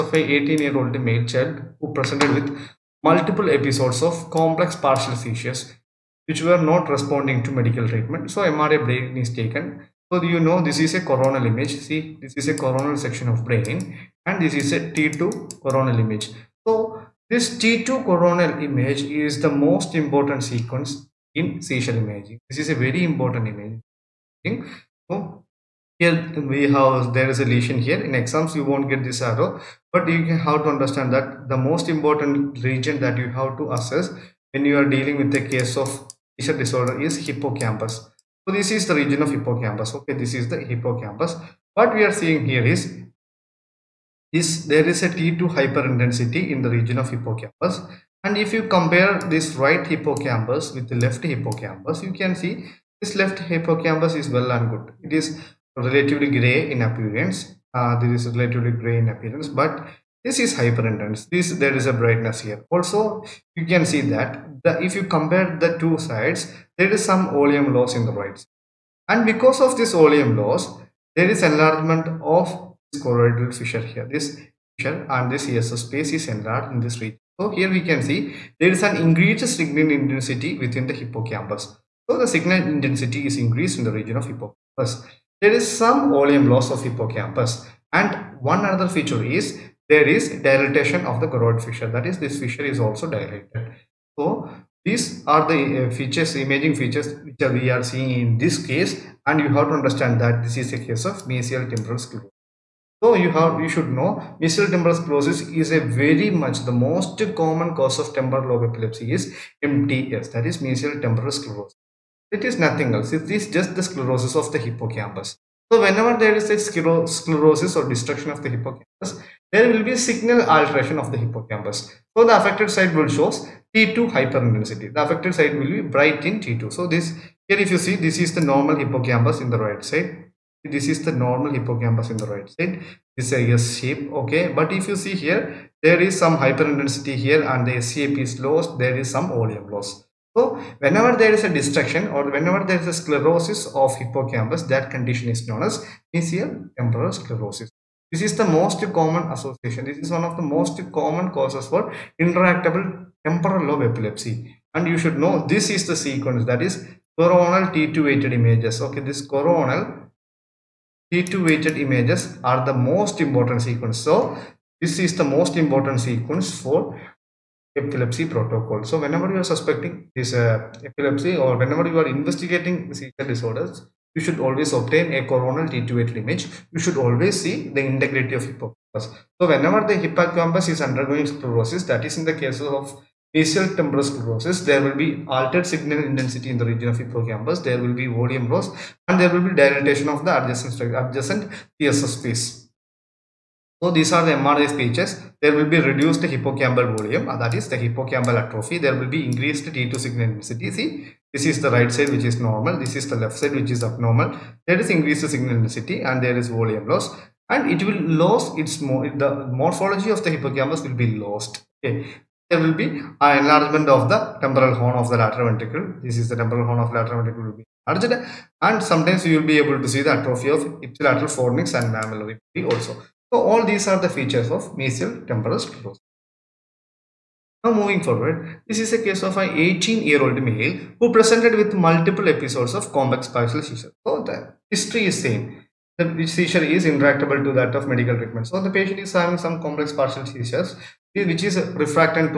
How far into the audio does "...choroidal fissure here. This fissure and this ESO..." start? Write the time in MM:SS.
01:13.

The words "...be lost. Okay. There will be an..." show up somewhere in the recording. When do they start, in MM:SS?
03:31.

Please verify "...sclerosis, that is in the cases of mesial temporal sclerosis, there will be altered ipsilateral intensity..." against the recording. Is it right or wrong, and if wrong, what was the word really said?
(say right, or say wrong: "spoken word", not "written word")
wrong: "signal", not "ipsilateral".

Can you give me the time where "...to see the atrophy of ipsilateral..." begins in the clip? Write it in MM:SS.
03:39.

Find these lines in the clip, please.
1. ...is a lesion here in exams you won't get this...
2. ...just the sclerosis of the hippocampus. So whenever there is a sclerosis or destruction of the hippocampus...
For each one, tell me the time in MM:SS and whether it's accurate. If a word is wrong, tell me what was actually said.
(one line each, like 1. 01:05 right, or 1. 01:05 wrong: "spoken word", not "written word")
1. 00:27 right
2. 01:53 right.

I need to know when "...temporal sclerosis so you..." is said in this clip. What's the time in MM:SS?
01:41.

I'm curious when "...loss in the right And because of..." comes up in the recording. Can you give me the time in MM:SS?
01:07.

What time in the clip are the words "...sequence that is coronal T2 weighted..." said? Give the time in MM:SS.
02:35.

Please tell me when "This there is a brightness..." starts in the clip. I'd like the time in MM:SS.
01:01.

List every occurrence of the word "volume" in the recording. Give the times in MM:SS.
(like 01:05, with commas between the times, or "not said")
01:26, 02:19, 03:08, 03:16, 03:26.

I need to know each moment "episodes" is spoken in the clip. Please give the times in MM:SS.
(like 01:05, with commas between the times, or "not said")
00:03, 03:52.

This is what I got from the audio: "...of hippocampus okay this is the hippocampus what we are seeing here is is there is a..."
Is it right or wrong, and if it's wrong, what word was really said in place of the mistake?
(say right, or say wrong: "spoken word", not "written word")
right.